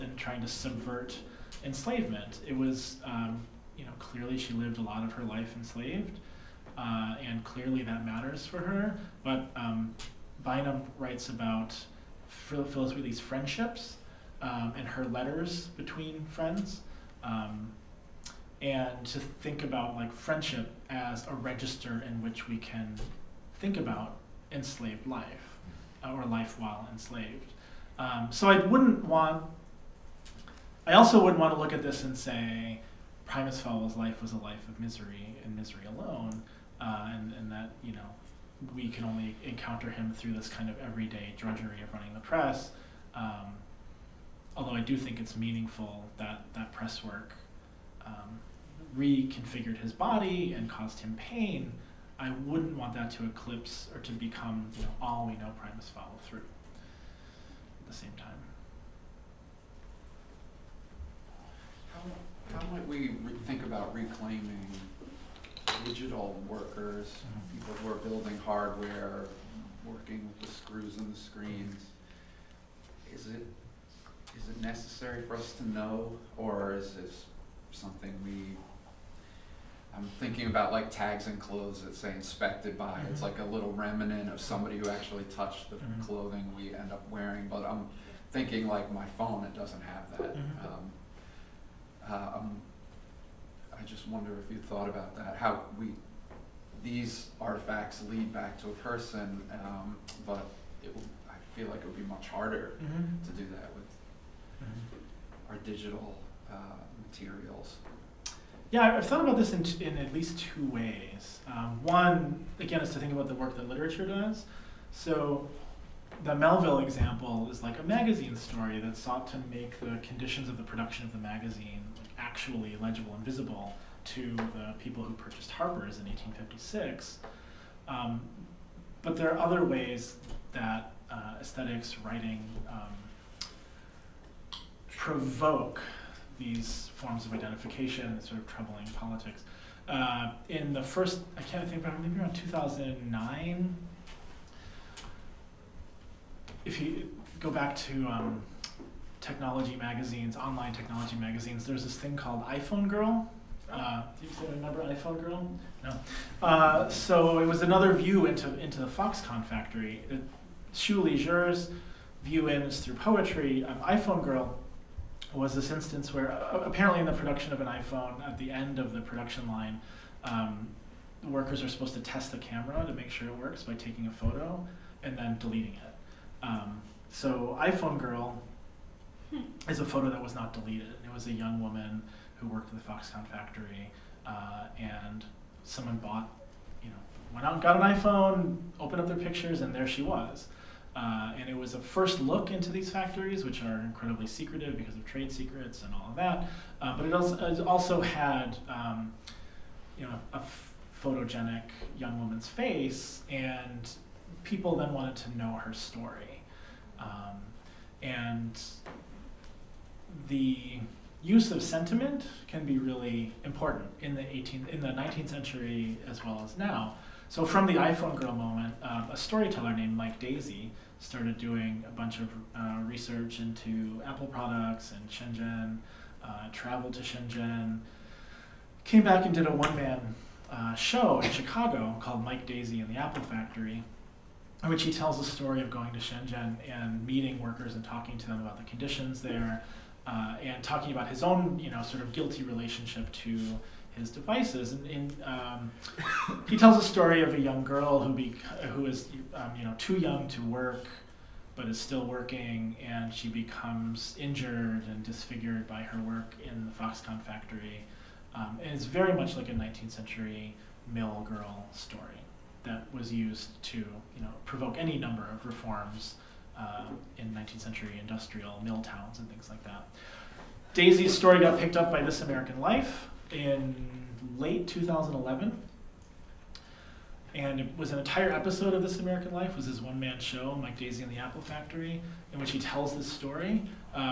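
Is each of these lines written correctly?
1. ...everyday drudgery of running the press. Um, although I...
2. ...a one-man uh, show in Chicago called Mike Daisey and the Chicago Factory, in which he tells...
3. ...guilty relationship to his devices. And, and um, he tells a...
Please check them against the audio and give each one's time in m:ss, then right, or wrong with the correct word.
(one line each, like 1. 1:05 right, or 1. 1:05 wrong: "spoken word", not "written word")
1. 0:40 right
2. 3:49 wrong: "Apple", not "Chicago"
3. 4:02 right.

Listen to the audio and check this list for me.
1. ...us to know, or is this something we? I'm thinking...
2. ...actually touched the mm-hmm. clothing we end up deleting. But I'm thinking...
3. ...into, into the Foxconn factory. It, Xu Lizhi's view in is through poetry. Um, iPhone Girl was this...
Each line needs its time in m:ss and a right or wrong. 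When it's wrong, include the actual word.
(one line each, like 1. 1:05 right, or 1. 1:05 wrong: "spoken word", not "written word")
1. 1:15 right
2. 1:24 wrong: "wearing", not "deleting"
3. 2:38 right.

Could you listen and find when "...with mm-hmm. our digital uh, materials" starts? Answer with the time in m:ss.
1:43.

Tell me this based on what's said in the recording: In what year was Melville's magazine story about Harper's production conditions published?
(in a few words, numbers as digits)
1856.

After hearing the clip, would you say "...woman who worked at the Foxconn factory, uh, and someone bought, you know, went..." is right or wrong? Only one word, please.
right.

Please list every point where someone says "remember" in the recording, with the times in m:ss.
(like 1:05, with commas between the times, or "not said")
2:34.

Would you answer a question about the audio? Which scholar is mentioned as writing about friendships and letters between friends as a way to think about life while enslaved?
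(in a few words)
Bynum.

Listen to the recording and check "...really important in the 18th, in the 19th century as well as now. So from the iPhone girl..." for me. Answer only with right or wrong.
right.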